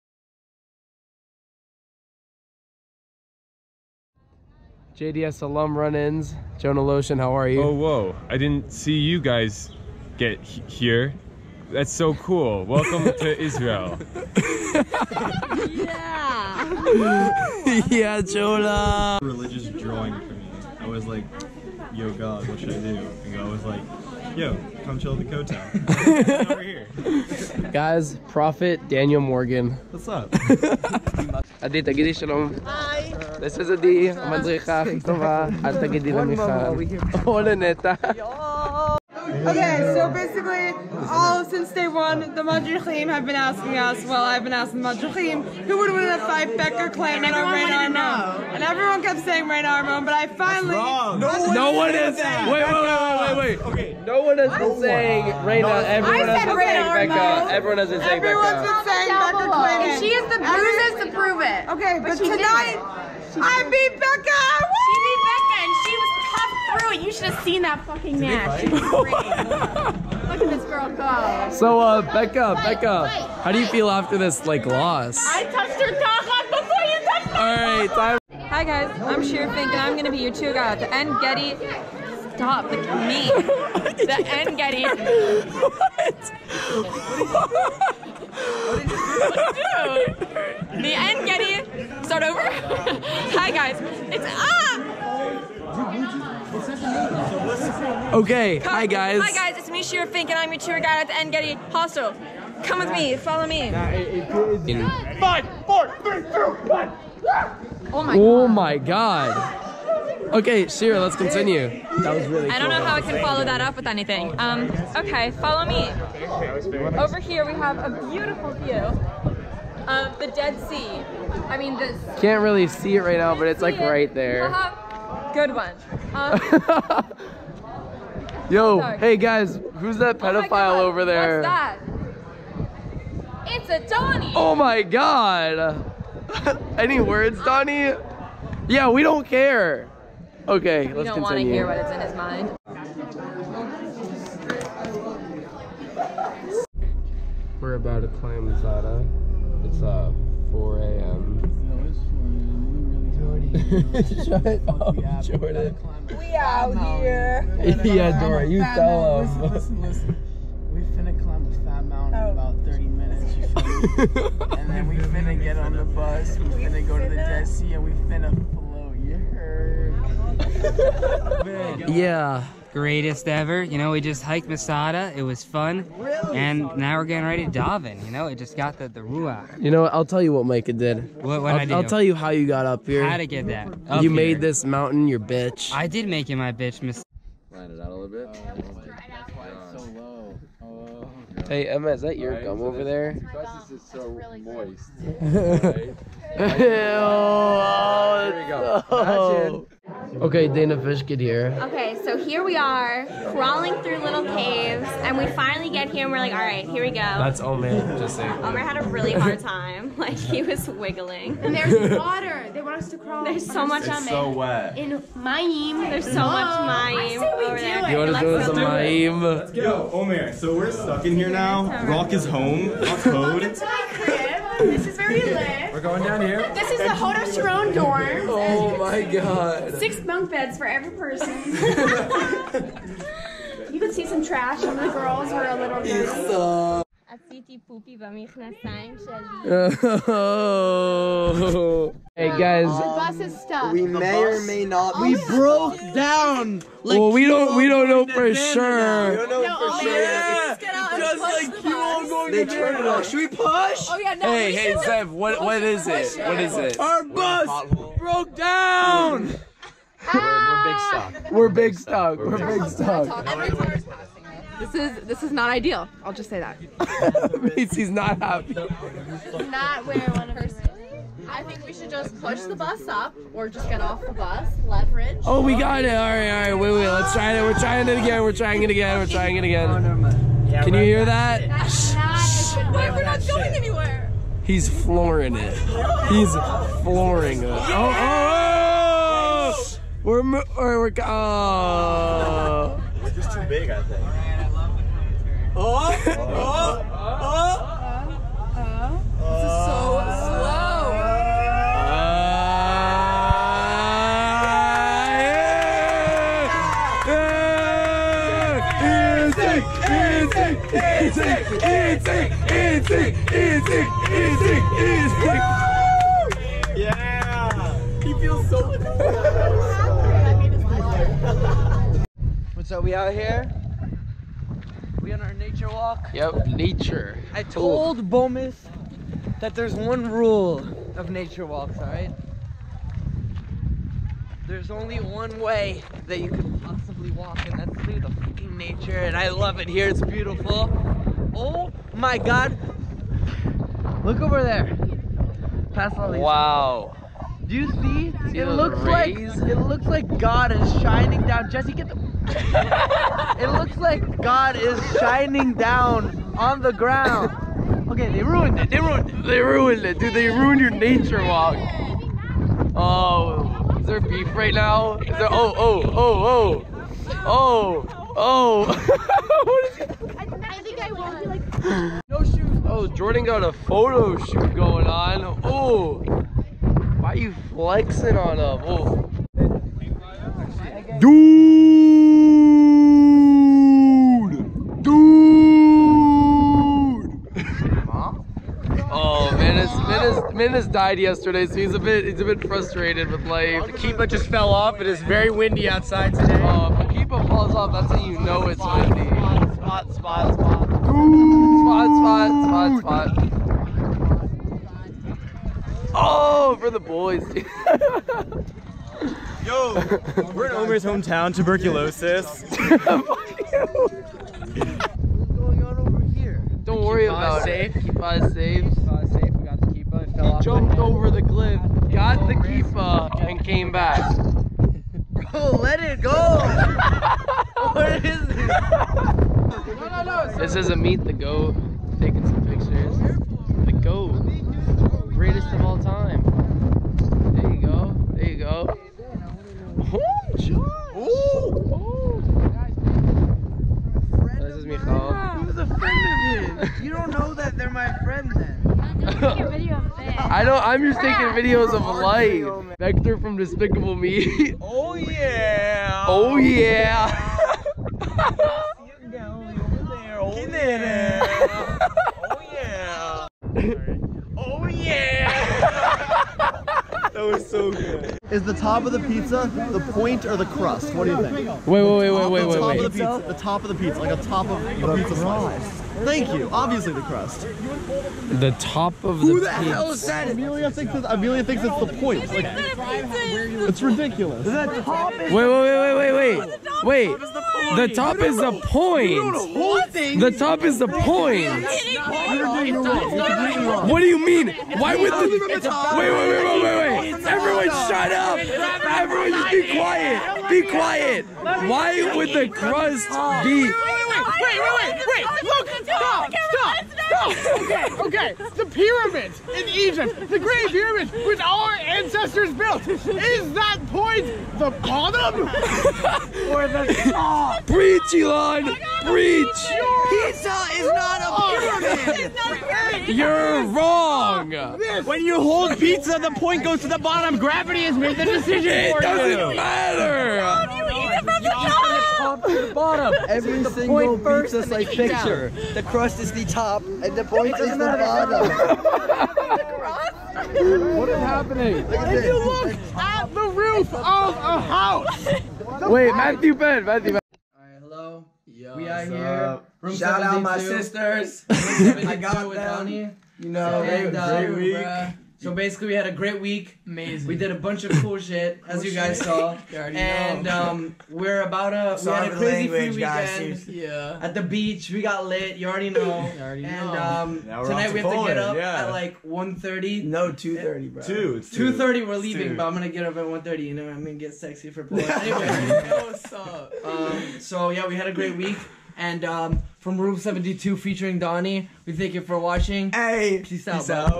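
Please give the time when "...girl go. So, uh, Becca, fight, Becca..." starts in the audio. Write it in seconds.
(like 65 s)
70 s.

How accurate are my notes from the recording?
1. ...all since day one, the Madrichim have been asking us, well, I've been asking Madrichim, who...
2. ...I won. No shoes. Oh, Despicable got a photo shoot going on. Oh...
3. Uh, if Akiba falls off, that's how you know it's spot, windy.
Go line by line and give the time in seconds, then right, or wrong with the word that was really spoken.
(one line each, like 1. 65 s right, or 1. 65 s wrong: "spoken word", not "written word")
1. 41 s right
2. 370 s wrong: "Jordan", not "Despicable"
3. 396 s right.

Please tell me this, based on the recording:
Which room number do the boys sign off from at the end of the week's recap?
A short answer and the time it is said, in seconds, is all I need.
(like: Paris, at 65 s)
72, at 579 s.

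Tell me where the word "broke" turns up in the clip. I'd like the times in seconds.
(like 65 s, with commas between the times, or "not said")
245 s, 257 s.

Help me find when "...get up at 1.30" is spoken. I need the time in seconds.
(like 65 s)
572 s.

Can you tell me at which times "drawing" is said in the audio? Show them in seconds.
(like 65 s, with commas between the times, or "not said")
19 s.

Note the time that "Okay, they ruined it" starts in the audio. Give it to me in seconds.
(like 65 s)
357 s.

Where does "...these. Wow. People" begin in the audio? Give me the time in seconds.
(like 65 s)
346 s.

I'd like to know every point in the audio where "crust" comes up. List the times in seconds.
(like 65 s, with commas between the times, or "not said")
470 s, 477 s, 502 s, 535 s.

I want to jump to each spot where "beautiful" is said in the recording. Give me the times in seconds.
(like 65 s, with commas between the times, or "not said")
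118 s, 340 s.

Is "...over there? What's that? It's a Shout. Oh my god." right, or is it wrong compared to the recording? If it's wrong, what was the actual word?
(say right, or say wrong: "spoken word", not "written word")
wrong: "Donnie", not "Shout".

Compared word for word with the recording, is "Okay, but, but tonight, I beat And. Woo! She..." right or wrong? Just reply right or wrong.
wrong.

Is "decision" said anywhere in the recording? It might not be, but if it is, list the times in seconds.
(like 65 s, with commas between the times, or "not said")
528 s.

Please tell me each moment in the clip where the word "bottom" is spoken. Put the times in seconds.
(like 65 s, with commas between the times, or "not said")
514 s, 526 s, 537 s.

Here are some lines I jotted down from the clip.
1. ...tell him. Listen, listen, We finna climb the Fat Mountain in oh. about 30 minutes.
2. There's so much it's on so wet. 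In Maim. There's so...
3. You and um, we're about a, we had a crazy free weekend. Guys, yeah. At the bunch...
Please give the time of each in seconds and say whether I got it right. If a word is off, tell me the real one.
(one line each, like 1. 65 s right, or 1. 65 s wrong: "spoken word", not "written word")
1. 158 s right
2. 213 s right
3. 559 s wrong: "beach", not "bunch".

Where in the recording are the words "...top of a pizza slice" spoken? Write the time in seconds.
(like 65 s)
474 s.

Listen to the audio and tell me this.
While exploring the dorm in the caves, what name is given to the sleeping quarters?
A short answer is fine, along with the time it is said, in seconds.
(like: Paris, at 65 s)
Hodos dorm, at 226 s.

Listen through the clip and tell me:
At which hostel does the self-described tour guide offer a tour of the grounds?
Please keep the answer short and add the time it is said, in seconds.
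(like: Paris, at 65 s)
Ein Gedi Hostel, at 101 s.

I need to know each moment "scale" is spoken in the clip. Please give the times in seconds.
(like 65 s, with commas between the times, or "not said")
not said.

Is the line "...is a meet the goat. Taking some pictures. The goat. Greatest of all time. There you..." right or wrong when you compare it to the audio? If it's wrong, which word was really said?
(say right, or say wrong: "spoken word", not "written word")
right.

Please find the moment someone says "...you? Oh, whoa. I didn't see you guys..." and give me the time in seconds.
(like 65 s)
7 s.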